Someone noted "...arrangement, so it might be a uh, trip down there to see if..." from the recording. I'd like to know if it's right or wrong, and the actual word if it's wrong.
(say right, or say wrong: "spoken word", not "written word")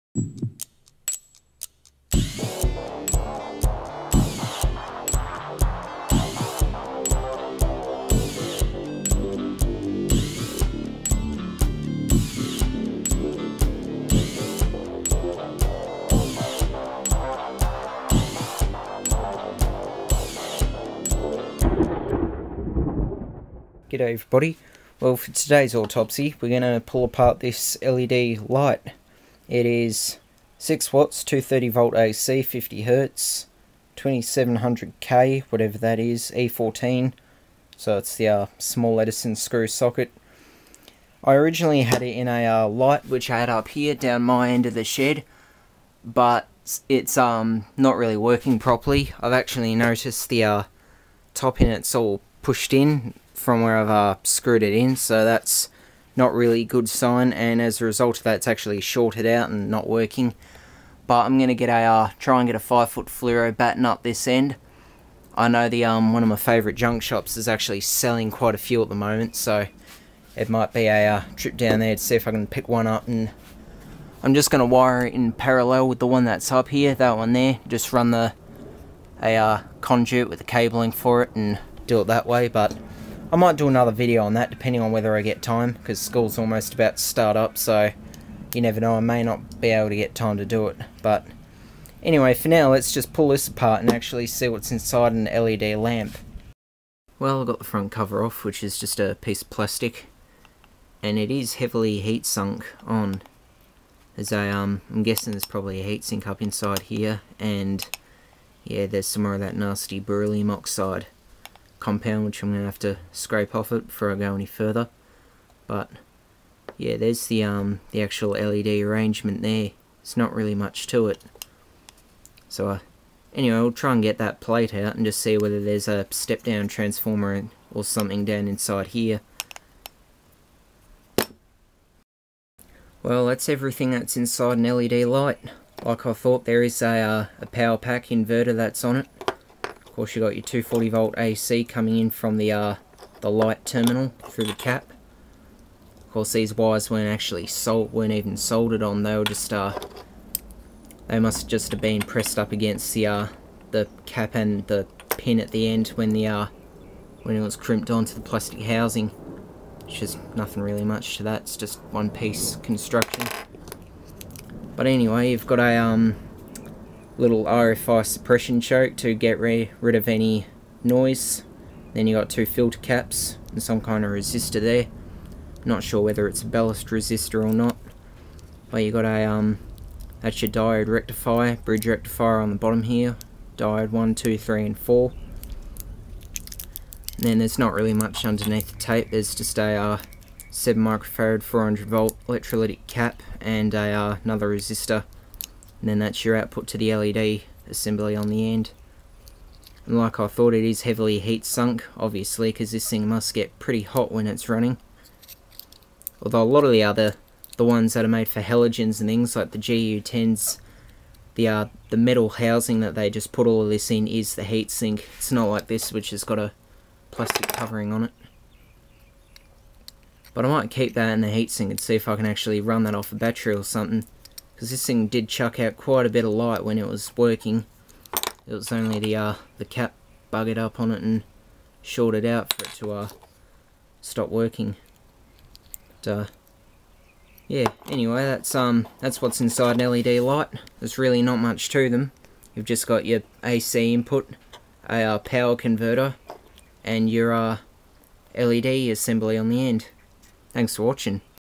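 wrong: "moment", not "arrangement".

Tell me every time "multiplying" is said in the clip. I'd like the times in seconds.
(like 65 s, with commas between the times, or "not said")
not said.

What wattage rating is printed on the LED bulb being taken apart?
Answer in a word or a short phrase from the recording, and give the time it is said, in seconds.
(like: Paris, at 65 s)
6 watts, at 30 s.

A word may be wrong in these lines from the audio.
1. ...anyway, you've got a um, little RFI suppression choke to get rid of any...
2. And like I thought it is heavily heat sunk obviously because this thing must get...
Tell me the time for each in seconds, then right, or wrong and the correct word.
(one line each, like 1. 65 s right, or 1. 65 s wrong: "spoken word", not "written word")
1. 164 s right
2. 199 s right.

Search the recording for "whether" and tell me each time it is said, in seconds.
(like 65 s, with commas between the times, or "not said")
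84 s, 125 s, 176 s.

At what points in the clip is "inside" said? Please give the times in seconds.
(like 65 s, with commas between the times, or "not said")
94 s, 106 s, 128 s, 134 s, 239 s.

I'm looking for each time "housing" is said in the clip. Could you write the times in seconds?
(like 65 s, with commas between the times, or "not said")
158 s, 212 s.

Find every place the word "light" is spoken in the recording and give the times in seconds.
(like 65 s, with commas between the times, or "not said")
28 s, 42 s, 135 s, 143 s, 226 s, 240 s.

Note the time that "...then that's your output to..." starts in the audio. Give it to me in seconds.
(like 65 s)
195 s.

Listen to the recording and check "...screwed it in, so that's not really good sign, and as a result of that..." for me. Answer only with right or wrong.
right.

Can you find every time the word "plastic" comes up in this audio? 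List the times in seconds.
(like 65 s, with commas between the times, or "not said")
99 s, 158 s, 217 s.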